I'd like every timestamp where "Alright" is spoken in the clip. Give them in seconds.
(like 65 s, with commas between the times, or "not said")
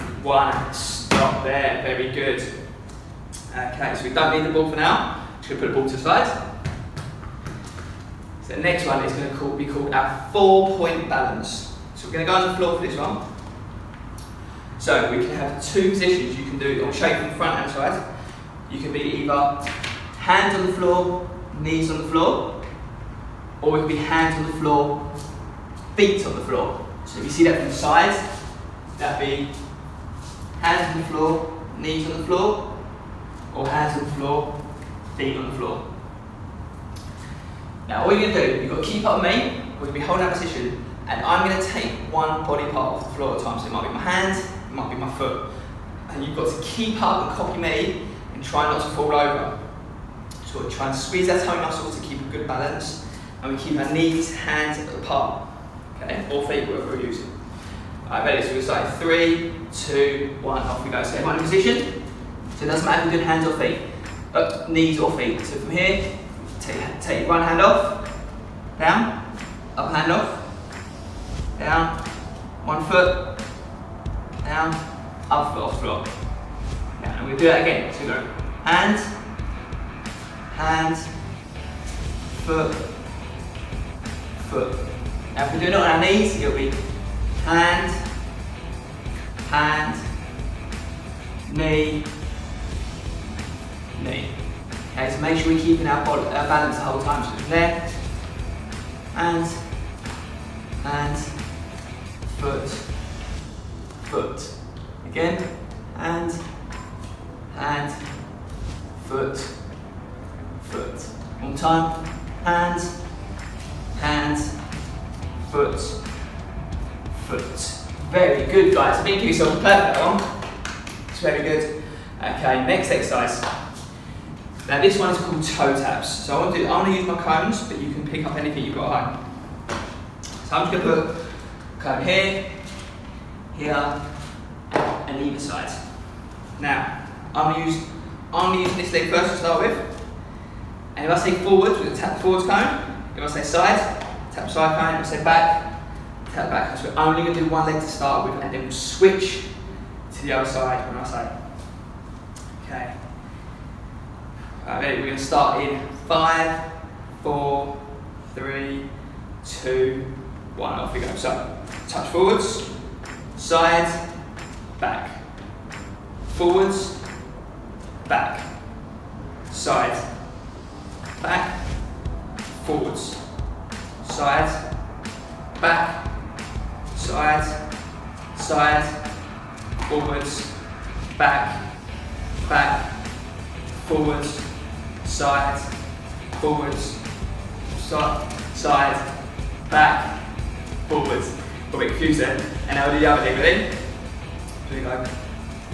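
58 s.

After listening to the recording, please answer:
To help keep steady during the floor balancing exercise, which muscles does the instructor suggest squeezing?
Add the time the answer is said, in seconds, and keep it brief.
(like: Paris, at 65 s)
Toe muscles, at 51 s.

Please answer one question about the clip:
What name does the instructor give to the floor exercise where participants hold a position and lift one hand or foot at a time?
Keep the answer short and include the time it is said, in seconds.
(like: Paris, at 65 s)
Four-point balance, at 10 s.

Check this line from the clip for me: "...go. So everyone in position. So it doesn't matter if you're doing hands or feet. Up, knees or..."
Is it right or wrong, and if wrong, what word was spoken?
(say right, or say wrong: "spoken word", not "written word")
right.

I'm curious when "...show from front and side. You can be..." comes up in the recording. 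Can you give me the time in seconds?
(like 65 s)
16 s.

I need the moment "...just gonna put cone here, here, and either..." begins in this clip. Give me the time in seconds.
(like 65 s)
130 s.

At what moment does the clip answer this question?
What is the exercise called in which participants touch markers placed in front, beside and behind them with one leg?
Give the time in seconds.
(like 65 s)
125 s.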